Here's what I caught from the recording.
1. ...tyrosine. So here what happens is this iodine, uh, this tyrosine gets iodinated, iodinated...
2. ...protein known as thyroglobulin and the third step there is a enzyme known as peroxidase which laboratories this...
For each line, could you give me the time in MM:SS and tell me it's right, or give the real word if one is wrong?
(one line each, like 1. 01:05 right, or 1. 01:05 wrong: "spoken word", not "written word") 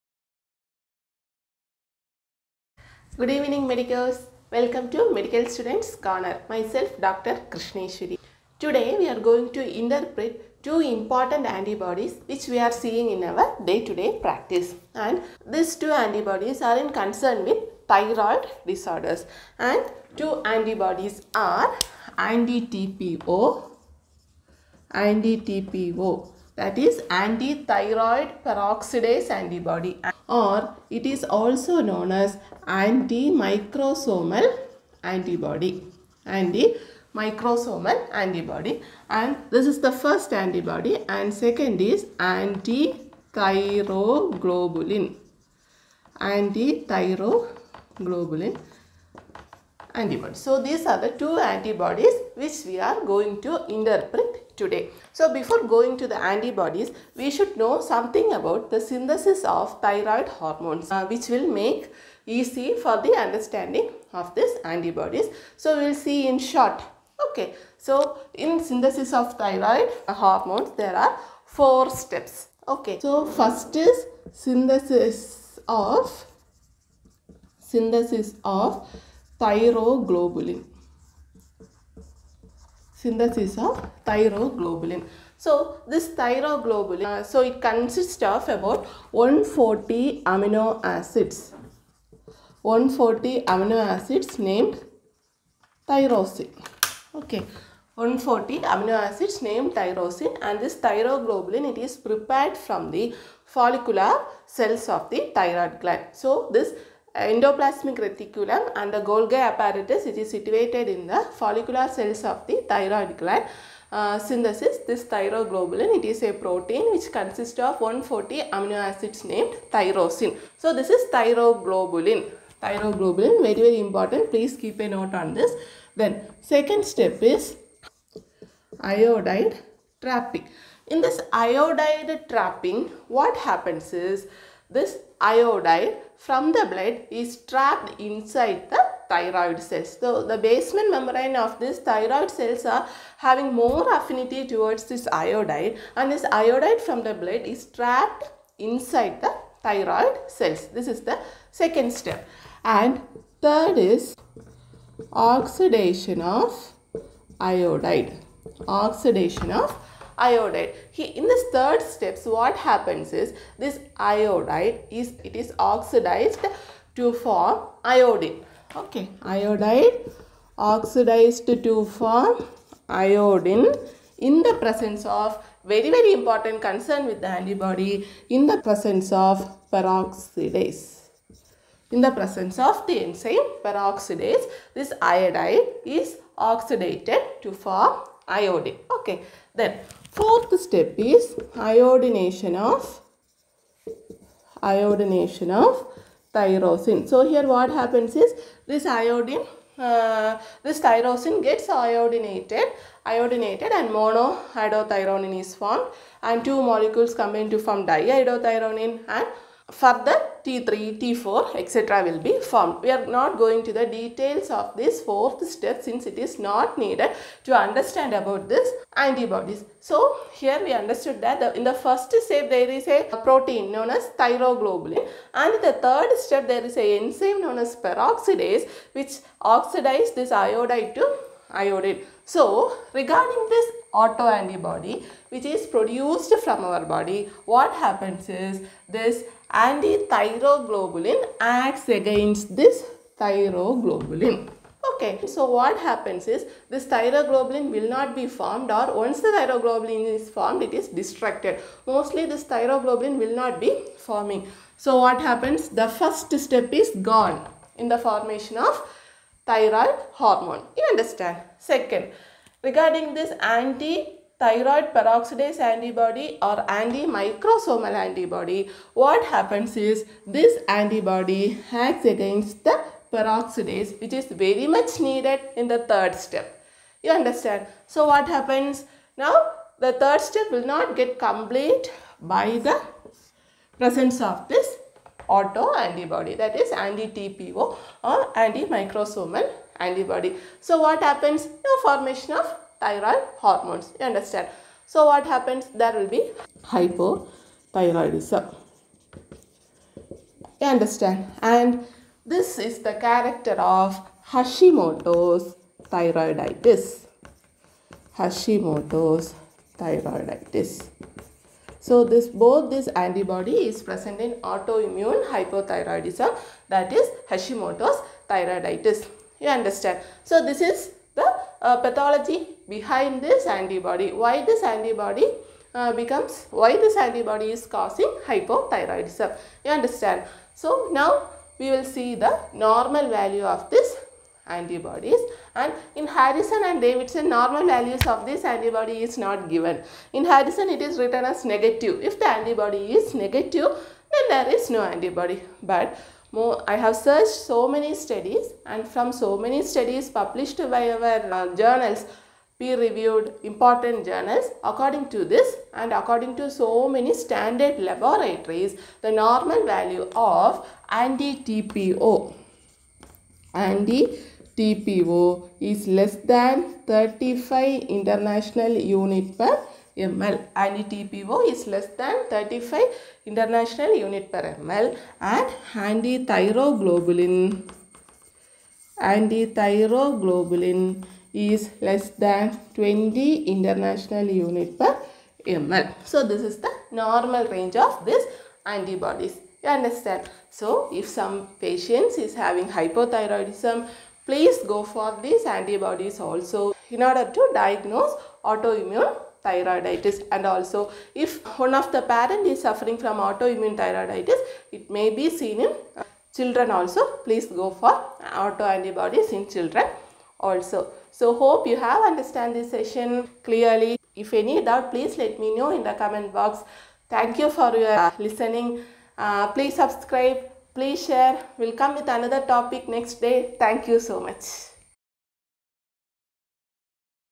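1. 03:16 right
2. 03:43 wrong: "oxidizes", not "laboratories".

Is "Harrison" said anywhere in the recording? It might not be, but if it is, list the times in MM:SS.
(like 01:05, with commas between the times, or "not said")
05:36, 05:40.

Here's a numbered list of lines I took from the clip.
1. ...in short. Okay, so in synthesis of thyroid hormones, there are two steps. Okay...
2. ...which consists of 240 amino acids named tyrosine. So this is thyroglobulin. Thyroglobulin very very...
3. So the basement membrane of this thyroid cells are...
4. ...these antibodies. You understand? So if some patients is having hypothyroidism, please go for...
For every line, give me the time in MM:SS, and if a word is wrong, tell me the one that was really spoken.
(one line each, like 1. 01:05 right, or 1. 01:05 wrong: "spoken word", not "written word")
1. 01:06 wrong: "four", not "two"
2. 01:56 wrong: "140", not "240"
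3. 02:19 right
4. 06:28 right.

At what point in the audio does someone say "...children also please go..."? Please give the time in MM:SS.
06:46.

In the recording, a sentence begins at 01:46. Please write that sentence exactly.
So this endoplasmic reticulum and the Golgi apparatus which is situated in the follicular cells of the thyroid gland.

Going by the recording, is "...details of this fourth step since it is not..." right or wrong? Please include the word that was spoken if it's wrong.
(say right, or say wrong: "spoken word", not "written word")
right.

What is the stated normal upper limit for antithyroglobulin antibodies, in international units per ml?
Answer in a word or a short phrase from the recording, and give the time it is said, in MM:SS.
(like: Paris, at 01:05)
20, at 06:22.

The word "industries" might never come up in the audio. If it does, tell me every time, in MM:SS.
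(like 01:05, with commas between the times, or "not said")
not said.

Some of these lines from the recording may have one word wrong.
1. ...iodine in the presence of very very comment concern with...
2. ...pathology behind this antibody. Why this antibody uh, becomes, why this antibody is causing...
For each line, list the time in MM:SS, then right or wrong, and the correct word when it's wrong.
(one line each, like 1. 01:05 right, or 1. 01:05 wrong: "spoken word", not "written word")
1. 02:52 wrong: "important", not "comment"
2. 05:21 right.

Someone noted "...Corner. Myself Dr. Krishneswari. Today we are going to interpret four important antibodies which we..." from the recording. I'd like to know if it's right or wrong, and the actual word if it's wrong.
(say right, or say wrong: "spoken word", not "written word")
wrong: "two", not "four".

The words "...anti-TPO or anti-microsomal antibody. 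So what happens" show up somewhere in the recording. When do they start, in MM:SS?
04:46.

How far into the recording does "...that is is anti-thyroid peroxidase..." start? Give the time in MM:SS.
00:26.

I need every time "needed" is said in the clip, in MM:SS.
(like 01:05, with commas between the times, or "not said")
03:36, 04:34.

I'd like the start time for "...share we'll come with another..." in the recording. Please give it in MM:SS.
07:01.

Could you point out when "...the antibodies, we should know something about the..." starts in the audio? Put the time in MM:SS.
00:56.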